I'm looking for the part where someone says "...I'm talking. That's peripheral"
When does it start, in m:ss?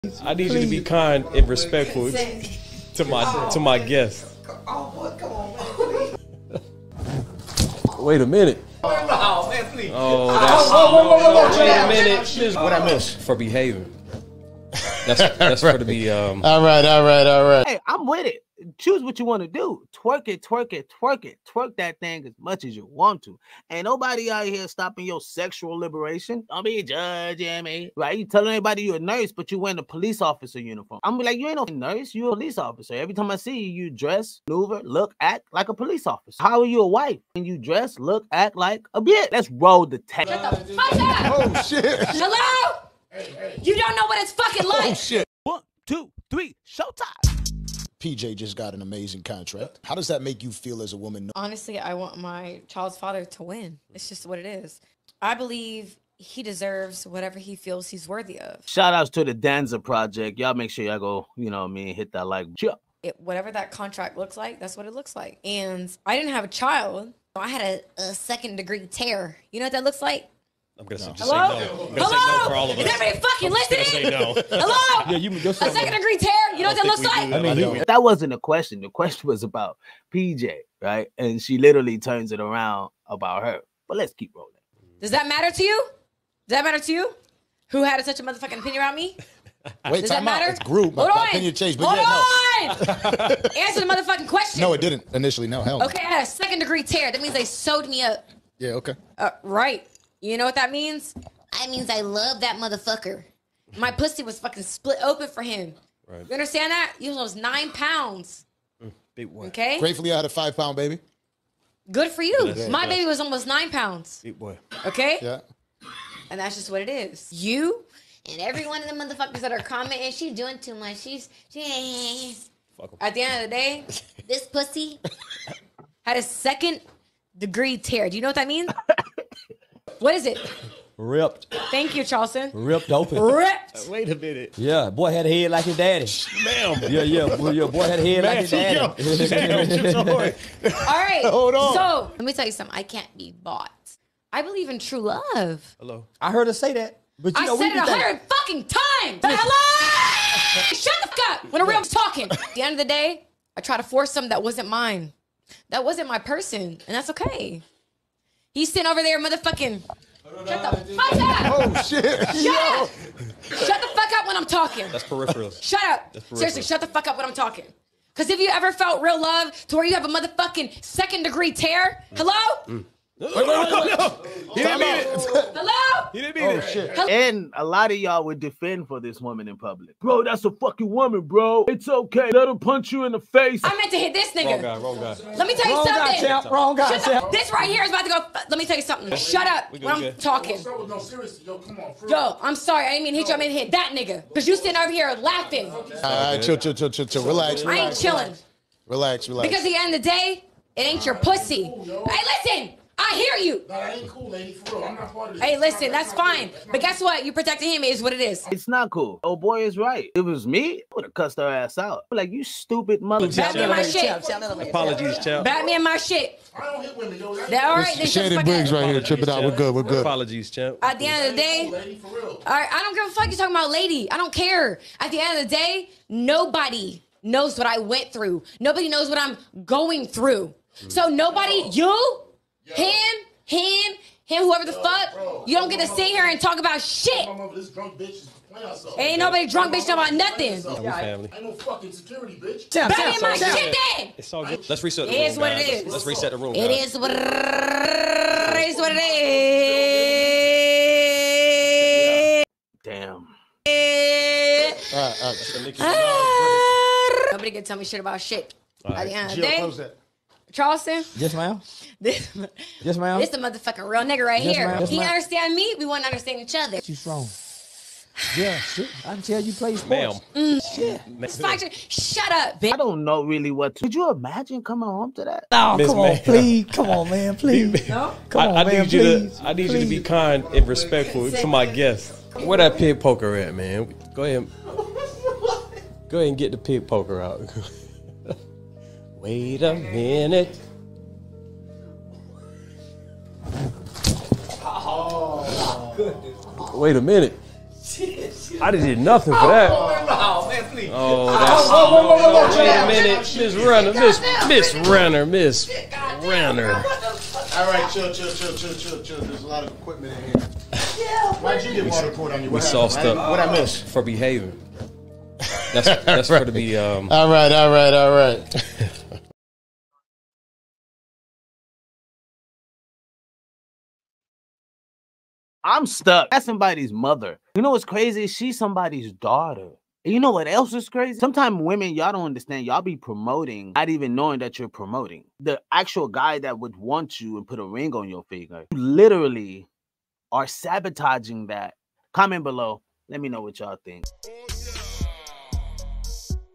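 2:44.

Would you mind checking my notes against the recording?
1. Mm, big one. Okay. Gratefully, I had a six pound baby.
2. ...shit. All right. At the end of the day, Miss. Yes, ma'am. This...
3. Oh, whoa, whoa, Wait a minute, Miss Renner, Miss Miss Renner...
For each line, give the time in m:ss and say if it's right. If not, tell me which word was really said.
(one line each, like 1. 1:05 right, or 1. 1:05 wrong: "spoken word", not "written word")
1. 1:48 wrong: "five", not "six"
2. 4:18 wrong: "Charleston", not "Miss"
3. 5:01 right.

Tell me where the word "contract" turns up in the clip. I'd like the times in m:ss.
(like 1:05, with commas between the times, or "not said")
0:49, 1:03.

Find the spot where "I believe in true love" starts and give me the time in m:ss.
2:24.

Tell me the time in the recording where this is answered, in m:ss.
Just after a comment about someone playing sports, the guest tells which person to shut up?
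4:31.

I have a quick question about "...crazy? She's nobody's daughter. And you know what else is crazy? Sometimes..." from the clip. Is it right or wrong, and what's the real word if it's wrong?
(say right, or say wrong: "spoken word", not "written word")
wrong: "somebody", not "nobody".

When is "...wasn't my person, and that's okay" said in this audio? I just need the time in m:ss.
2:35.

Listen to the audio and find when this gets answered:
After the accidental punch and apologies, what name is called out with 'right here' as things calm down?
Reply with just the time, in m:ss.
3:38.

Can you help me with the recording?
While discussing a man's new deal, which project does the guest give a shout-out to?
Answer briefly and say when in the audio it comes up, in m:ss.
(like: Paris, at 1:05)
Danza Project, at 0:59.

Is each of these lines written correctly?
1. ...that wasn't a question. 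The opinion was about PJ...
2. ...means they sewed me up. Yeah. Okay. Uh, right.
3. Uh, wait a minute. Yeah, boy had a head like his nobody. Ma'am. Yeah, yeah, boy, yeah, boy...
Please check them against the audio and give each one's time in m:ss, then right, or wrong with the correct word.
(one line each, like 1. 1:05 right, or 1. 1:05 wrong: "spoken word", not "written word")
1. 1:17 wrong: "question", not "opinion"
2. 1:37 right
3. 2:13 wrong: "daddy", not "nobody".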